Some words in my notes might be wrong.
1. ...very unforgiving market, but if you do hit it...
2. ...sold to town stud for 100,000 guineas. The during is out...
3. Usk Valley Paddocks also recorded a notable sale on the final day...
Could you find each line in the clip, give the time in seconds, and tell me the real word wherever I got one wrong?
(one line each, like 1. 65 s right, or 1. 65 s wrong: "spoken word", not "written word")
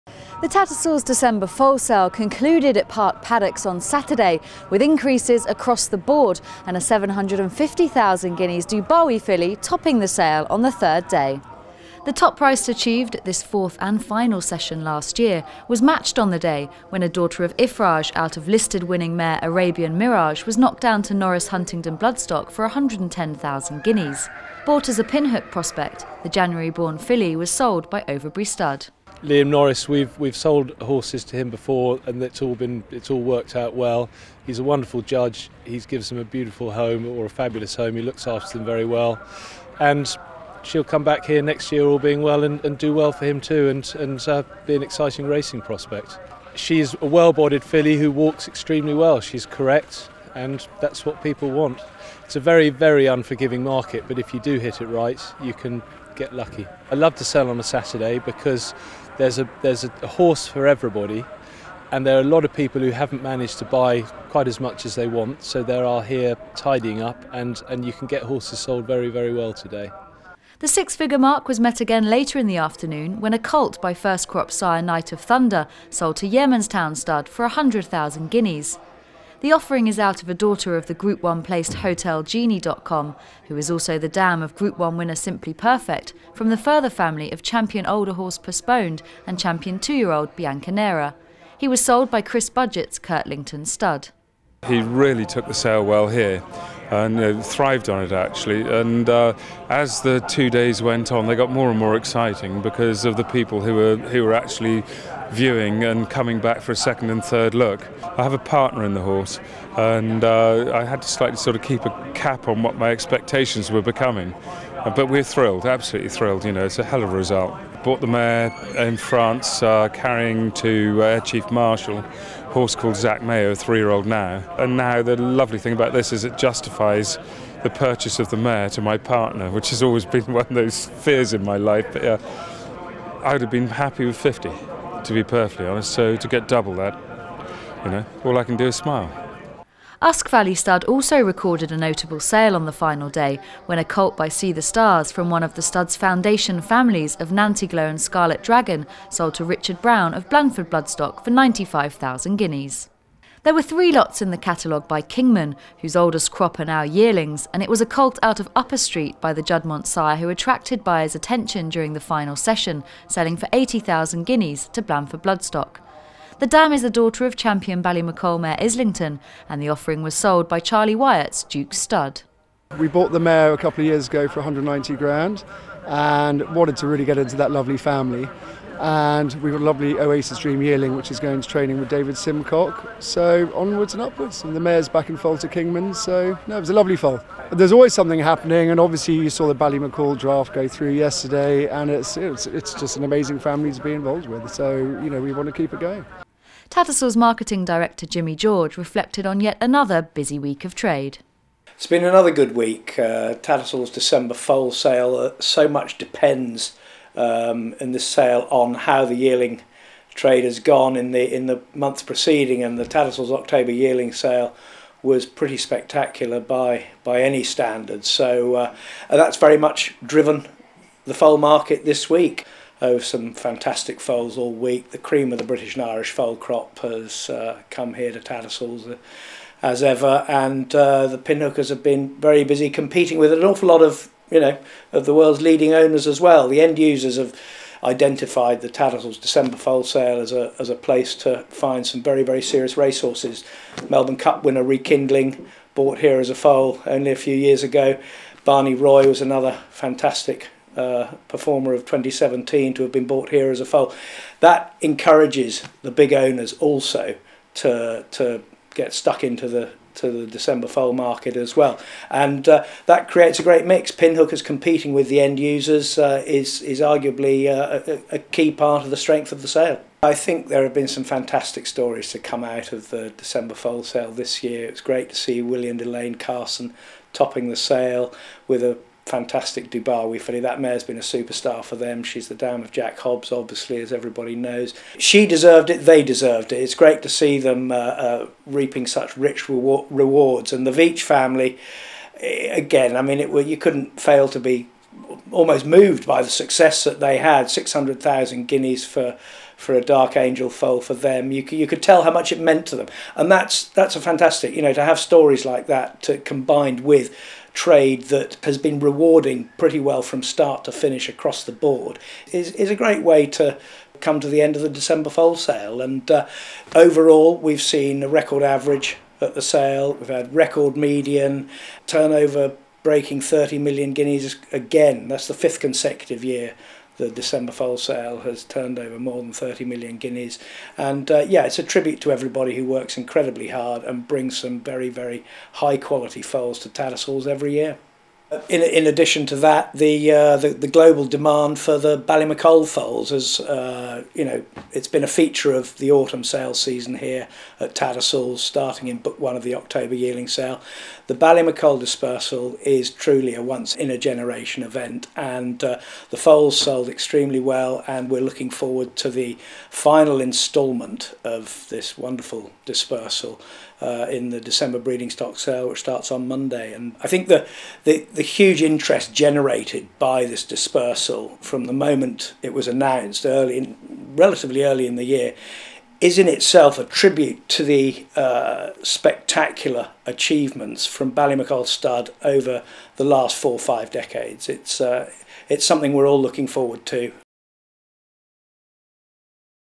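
1. 52 s right
2. 75 s wrong: "offering", not "during"
3. 140 s wrong: "Stud", not "Paddocks".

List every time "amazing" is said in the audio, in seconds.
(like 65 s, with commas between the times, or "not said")
193 s.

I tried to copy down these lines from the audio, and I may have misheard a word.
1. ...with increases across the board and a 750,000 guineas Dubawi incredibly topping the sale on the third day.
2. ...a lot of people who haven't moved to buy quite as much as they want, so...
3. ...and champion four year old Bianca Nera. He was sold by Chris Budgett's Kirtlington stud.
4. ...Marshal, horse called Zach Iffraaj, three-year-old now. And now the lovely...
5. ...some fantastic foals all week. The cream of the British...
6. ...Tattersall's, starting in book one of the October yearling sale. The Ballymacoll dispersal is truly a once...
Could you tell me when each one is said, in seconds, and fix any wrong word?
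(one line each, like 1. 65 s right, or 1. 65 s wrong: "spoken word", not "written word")
1. 4 s wrong: "filly", not "incredibly"
2. 62 s wrong: "managed", not "moved"
3. 89 s wrong: "two", not "four"
4. 121 s wrong: "Mayo", not "Iffraaj"
5. 222 s right
6. 347 s right.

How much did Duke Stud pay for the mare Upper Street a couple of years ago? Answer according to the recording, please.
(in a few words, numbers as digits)
190 grand.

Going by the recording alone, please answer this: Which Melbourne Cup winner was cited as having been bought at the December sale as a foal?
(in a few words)
Rekindling.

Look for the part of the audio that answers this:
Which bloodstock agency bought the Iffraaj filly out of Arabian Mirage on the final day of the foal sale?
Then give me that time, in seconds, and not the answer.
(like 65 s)
21 s.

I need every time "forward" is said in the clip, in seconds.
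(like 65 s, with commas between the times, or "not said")
358 s, 386 s.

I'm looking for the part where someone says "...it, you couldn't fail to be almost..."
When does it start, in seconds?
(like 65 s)
293 s.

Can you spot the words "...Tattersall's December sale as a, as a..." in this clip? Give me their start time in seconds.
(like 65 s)
238 s.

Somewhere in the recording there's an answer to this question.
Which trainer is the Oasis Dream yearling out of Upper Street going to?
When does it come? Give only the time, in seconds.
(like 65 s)
181 s.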